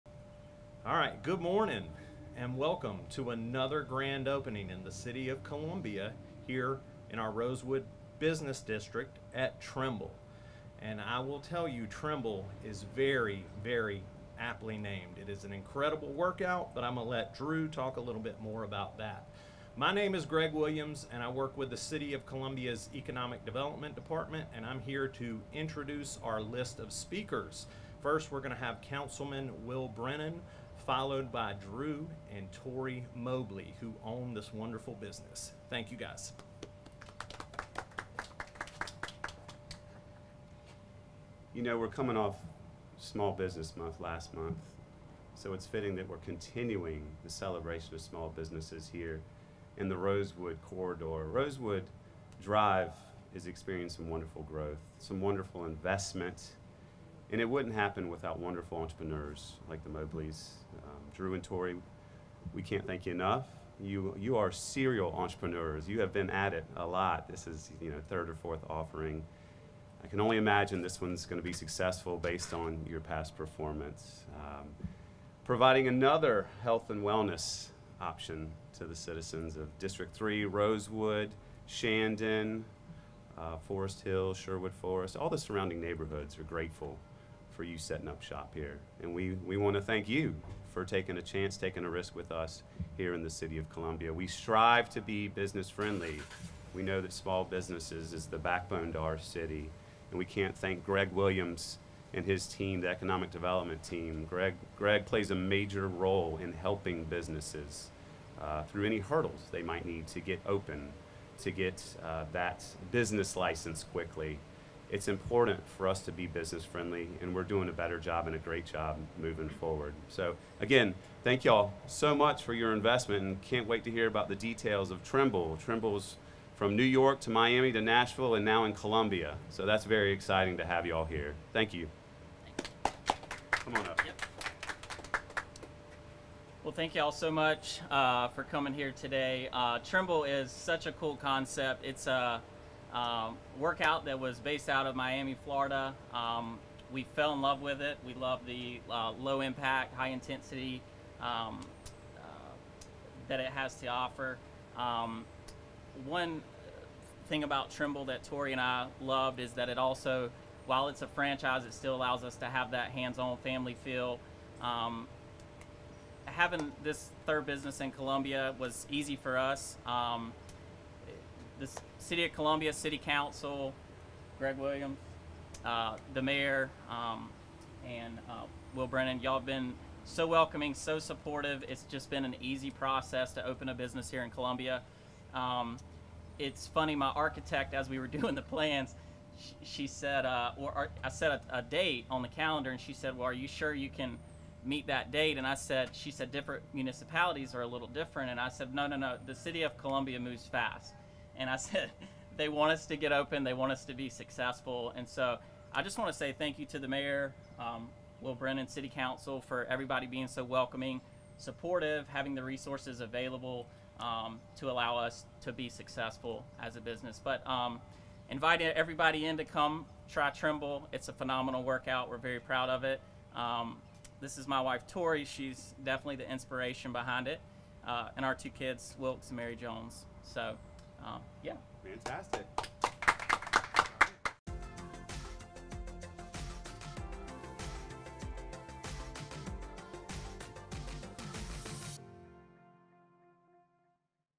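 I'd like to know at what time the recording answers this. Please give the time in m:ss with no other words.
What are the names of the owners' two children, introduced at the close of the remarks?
3:48.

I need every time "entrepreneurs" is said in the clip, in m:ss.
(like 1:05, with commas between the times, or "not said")
0:58, 1:05.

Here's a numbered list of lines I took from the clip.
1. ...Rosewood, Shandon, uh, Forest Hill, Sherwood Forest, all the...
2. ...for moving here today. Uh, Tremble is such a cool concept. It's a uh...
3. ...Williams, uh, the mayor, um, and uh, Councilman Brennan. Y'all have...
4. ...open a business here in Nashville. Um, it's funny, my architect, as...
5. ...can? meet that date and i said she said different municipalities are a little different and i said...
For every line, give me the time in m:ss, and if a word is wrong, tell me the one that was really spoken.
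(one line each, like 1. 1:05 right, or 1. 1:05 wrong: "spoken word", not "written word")
1. 1:20 right
2. 2:18 wrong: "coming", not "moving"
3. 2:54 wrong: "Will", not "Councilman"
4. 3:03 wrong: "Columbia", not "Nashville"
5. 3:13 right.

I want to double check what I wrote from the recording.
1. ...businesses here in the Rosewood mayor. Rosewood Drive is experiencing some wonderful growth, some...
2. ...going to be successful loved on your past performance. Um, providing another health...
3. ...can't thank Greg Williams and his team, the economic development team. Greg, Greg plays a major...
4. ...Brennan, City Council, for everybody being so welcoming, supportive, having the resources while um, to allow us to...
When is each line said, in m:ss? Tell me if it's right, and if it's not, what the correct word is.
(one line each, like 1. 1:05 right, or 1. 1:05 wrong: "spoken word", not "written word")
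1. 0:48 wrong: "corridor", not "mayor"
2. 1:11 wrong: "based", not "loved"
3. 1:40 right
4. 3:28 wrong: "available", not "while".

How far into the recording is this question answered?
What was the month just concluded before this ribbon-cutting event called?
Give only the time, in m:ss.
0:42.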